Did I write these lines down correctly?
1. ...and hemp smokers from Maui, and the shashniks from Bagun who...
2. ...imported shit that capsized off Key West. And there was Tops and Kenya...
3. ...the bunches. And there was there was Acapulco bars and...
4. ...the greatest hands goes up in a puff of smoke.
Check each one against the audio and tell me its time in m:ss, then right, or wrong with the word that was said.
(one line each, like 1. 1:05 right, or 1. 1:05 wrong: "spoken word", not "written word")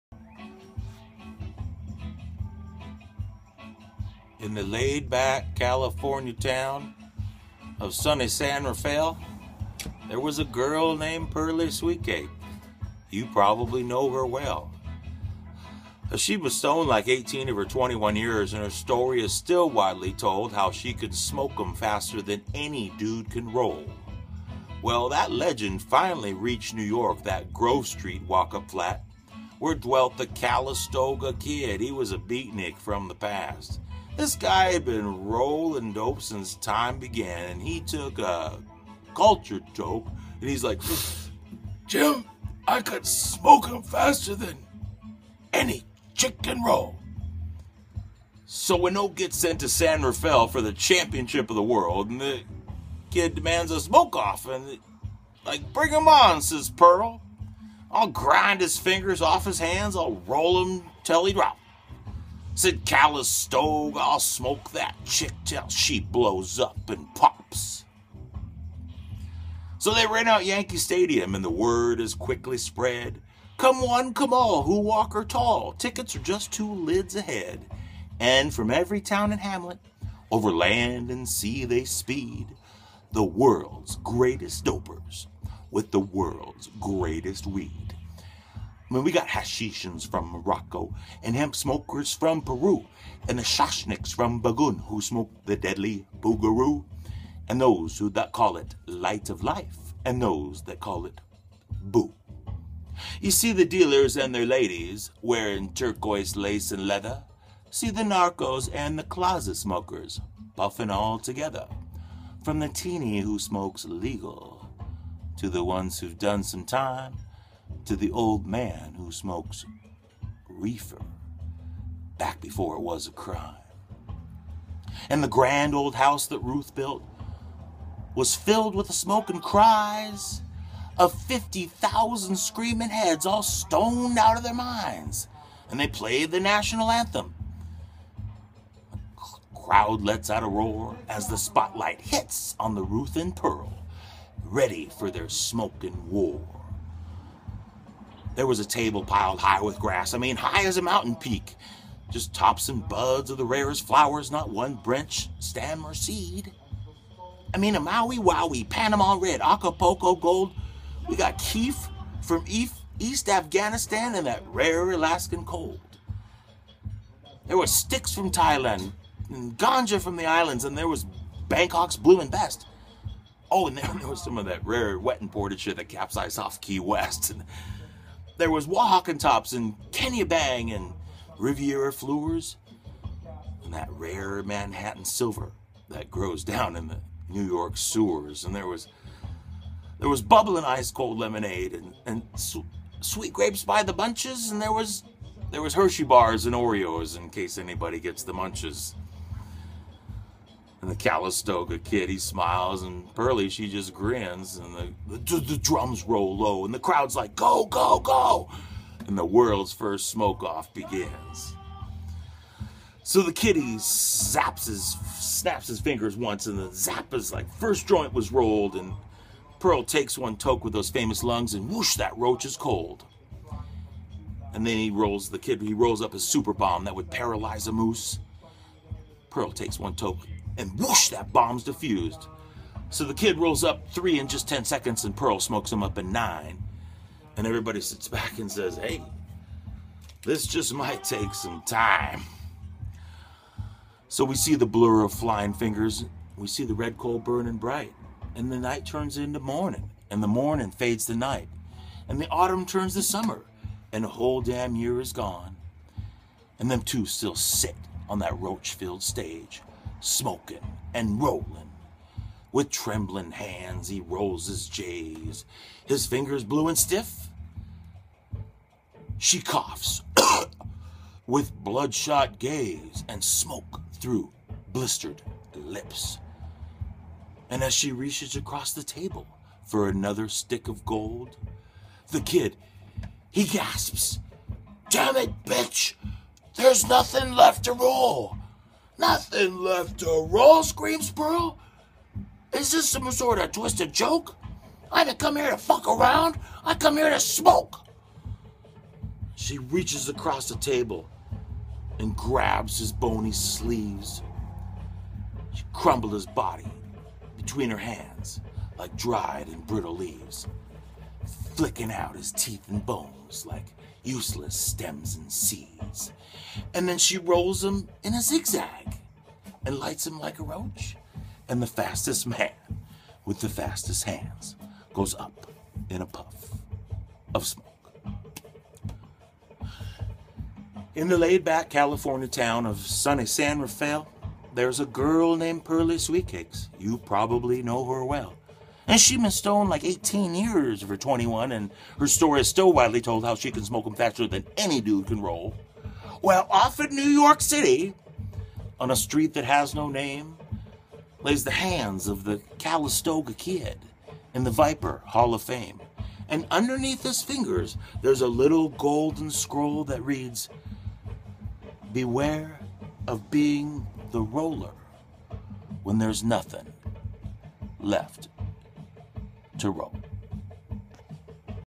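1. 1:31 wrong: "Peru", not "Maui"
2. 2:55 right
3. 3:13 wrong: "Hershey", not "Acapulco"
4. 5:23 wrong: "fastest", not "greatest".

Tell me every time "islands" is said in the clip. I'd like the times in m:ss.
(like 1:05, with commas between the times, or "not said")
2:50.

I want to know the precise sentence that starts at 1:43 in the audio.
You see the dealers and their ladies wearing turquoise lace and leather.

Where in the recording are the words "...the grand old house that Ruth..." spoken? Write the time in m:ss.
2:05.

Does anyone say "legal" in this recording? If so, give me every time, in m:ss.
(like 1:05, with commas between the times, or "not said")
1:53.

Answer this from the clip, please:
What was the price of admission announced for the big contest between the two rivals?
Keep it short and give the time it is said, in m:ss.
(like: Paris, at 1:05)
two lids, at 1:16.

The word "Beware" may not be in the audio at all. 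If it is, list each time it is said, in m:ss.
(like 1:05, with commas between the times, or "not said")
6:01.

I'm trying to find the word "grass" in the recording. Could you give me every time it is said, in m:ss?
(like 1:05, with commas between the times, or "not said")
2:29.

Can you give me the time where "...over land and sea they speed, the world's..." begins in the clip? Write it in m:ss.
1:20.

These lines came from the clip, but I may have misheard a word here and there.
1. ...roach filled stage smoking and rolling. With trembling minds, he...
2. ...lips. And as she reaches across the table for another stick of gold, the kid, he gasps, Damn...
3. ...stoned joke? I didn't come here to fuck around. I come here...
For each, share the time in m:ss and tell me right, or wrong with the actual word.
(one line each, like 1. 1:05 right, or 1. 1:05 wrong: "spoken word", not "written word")
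1. 4:18 wrong: "hands", not "minds"
2. 4:35 right
3. 4:53 wrong: "twisted", not "stoned".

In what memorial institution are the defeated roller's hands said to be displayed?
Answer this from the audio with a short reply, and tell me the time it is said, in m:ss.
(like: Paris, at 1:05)
Viper Hall of Fame, at 5:54.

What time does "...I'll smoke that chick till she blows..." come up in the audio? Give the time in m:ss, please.
1:03.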